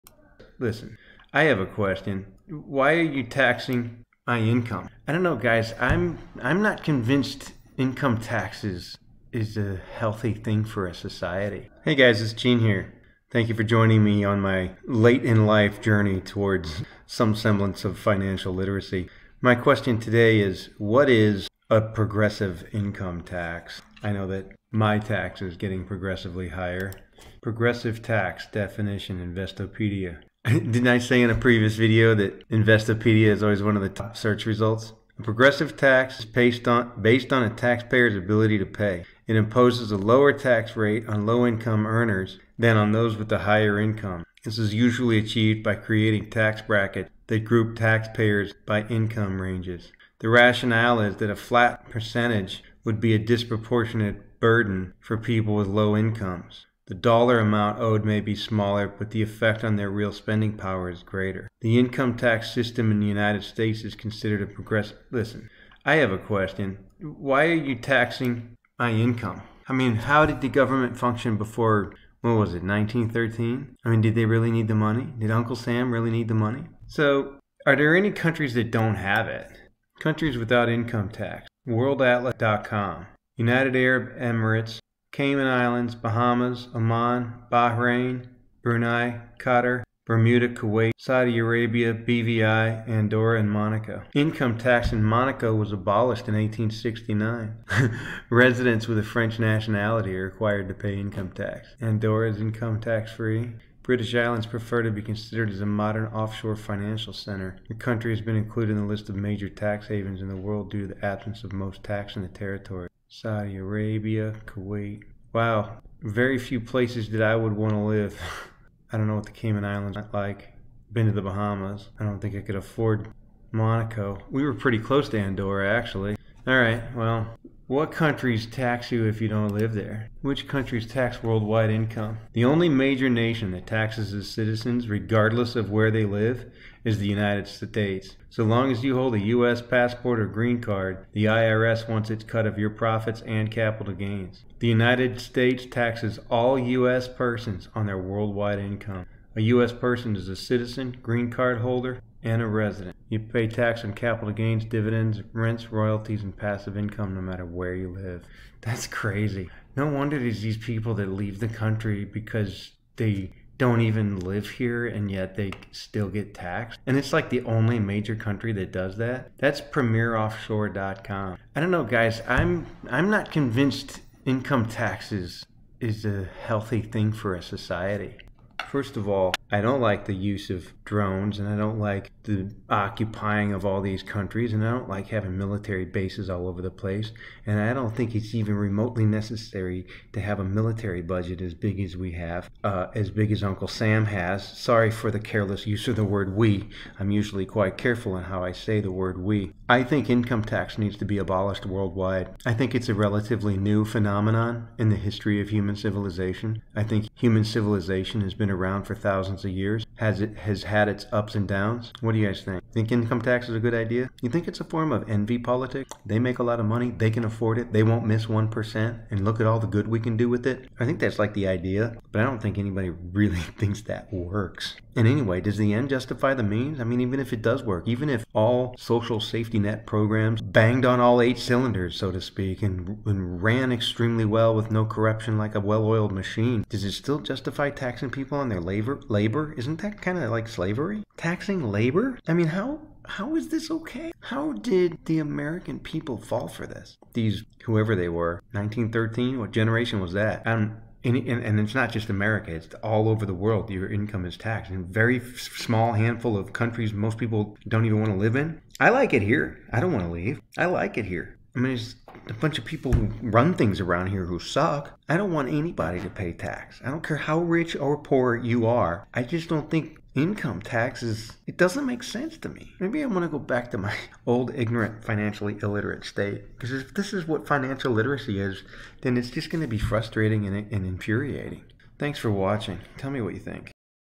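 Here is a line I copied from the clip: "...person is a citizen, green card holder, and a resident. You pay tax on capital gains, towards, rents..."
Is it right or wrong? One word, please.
wrong.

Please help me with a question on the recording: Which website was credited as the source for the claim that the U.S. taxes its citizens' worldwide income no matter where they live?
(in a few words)
premieroffshore.com.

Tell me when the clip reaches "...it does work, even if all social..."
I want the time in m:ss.
3:47.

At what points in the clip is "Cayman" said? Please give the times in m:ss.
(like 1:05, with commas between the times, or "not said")
1:25, 1:59.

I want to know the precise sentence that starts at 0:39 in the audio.
It imposes a lower tax rate on low income earners than on those with a higher income.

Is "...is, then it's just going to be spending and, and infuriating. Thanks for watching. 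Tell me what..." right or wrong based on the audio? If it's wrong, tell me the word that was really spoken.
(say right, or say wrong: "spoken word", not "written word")
wrong: "frustrating", not "spending".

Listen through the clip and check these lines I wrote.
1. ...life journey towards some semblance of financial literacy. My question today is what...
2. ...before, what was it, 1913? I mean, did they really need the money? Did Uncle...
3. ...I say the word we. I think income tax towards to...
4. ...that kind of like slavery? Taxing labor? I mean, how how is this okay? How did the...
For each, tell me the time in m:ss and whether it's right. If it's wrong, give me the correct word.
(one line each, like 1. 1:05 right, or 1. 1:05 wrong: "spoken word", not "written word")
1. 0:15 right
2. 1:11 right
3. 3:18 wrong: "needs", not "towards"
4. 3:59 right.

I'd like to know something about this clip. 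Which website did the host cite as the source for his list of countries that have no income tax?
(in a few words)
WorldAtlas.com.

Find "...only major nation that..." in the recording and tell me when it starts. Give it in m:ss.
2:12.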